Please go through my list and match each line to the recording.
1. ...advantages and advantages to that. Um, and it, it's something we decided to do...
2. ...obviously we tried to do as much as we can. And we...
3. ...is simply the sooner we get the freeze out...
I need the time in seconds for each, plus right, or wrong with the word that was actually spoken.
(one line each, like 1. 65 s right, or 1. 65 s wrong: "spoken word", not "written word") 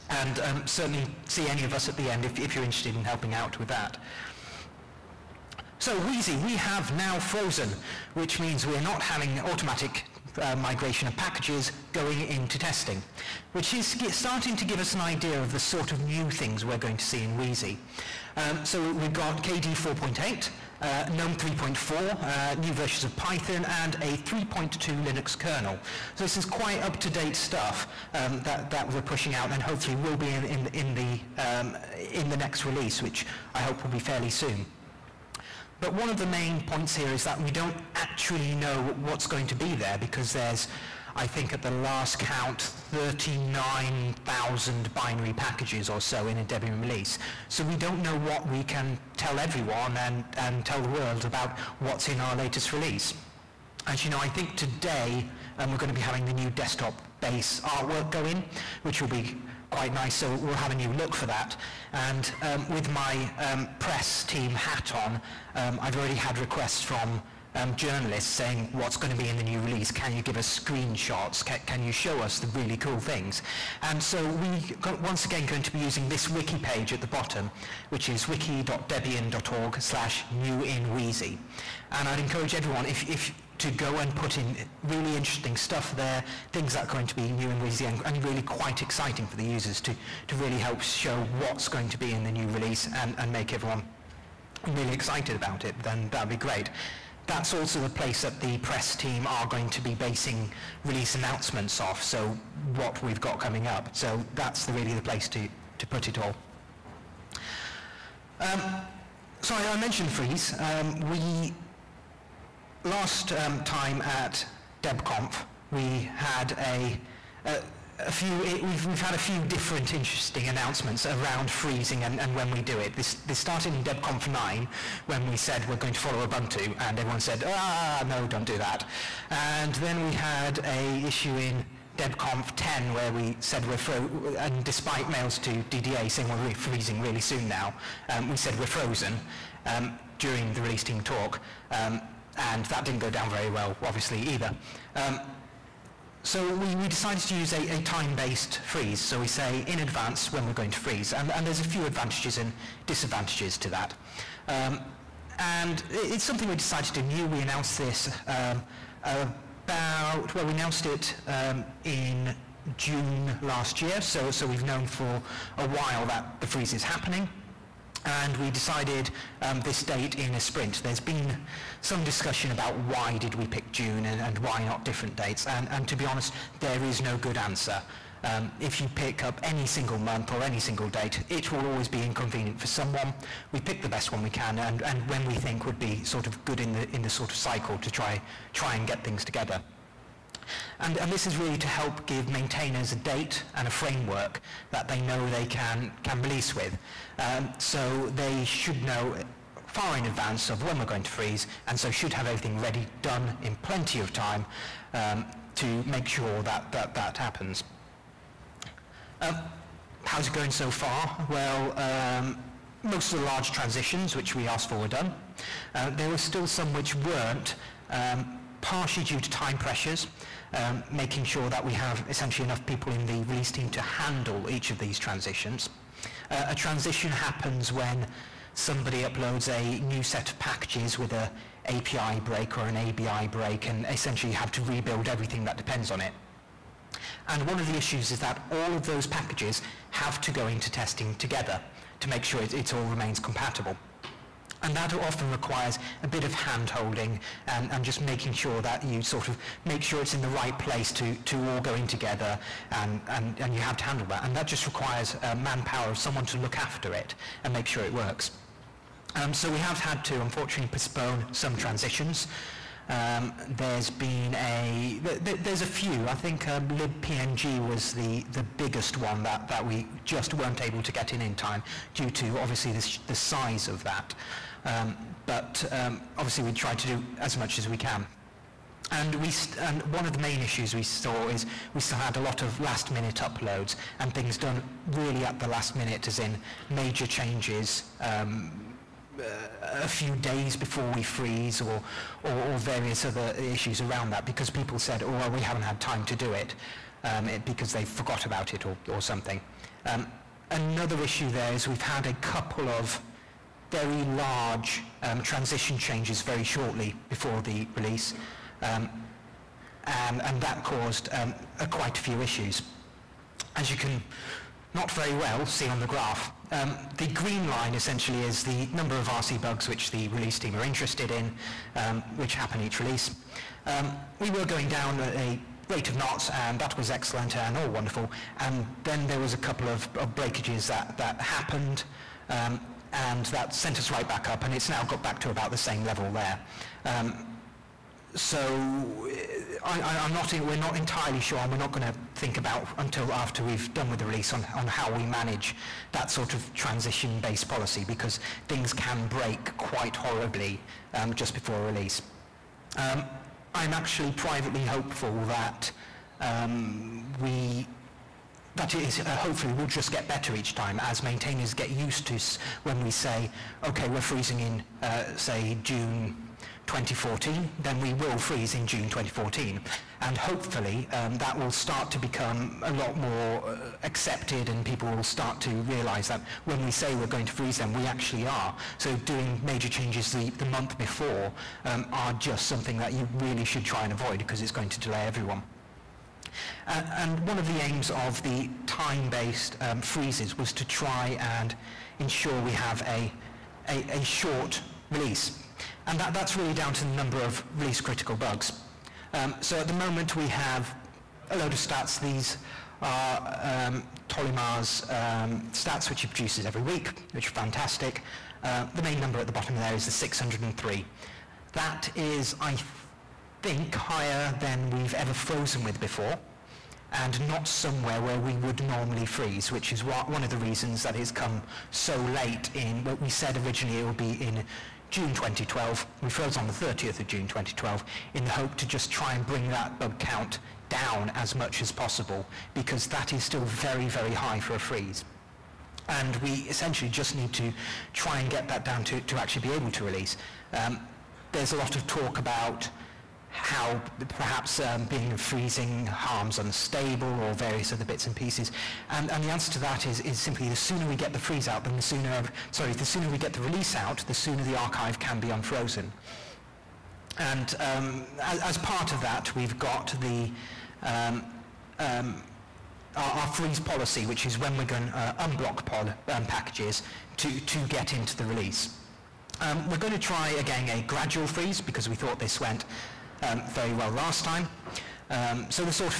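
1. 151 s wrong: "disadvantages", not "advantages"
2. 276 s right
3. 450 s right.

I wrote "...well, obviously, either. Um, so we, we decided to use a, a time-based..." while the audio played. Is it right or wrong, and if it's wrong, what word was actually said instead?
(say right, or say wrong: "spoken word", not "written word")
right.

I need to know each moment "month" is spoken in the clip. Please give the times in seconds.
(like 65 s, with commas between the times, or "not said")
179 s, 380 s.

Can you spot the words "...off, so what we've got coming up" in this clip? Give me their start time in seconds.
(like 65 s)
101 s.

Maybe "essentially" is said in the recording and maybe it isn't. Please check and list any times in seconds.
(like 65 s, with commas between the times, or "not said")
222 s, 233 s, 317 s, 436 s.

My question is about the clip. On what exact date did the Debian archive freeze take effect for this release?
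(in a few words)
30 June 2012.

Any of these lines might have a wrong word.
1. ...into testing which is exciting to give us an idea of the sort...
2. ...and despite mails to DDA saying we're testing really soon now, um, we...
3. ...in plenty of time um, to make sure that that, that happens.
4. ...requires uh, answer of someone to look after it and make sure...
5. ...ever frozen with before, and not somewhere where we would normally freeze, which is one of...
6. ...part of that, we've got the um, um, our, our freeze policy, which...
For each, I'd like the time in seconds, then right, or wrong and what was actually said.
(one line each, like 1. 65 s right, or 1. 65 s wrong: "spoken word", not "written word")
1. 12 s wrong: "starting", not "exciting"
2. 134 s wrong: "freezing", not "testing"
3. 203 s right
4. 254 s wrong: "manpower", not "answer"
5. 414 s right
6. 458 s right.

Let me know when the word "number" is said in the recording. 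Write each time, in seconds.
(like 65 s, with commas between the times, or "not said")
318 s, 396 s, 408 s.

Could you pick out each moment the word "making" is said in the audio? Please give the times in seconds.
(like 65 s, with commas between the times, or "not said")
220 s, 247 s.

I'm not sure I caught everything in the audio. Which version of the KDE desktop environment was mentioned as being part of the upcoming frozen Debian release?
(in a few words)
4.8.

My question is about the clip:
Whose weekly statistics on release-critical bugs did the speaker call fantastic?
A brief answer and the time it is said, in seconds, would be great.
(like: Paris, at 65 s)
Tolimar, at 404 s.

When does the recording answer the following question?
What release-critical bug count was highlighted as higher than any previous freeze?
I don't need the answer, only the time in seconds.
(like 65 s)
409 s.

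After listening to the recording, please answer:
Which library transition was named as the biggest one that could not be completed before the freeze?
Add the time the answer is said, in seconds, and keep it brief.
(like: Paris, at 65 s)
libpng, at 266 s.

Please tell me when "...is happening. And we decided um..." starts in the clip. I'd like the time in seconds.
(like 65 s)
166 s.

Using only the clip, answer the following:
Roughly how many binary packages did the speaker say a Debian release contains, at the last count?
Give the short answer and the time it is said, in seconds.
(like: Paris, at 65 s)
39,000, at 42 s.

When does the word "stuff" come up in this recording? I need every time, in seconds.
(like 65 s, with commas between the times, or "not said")
27 s, 85 s.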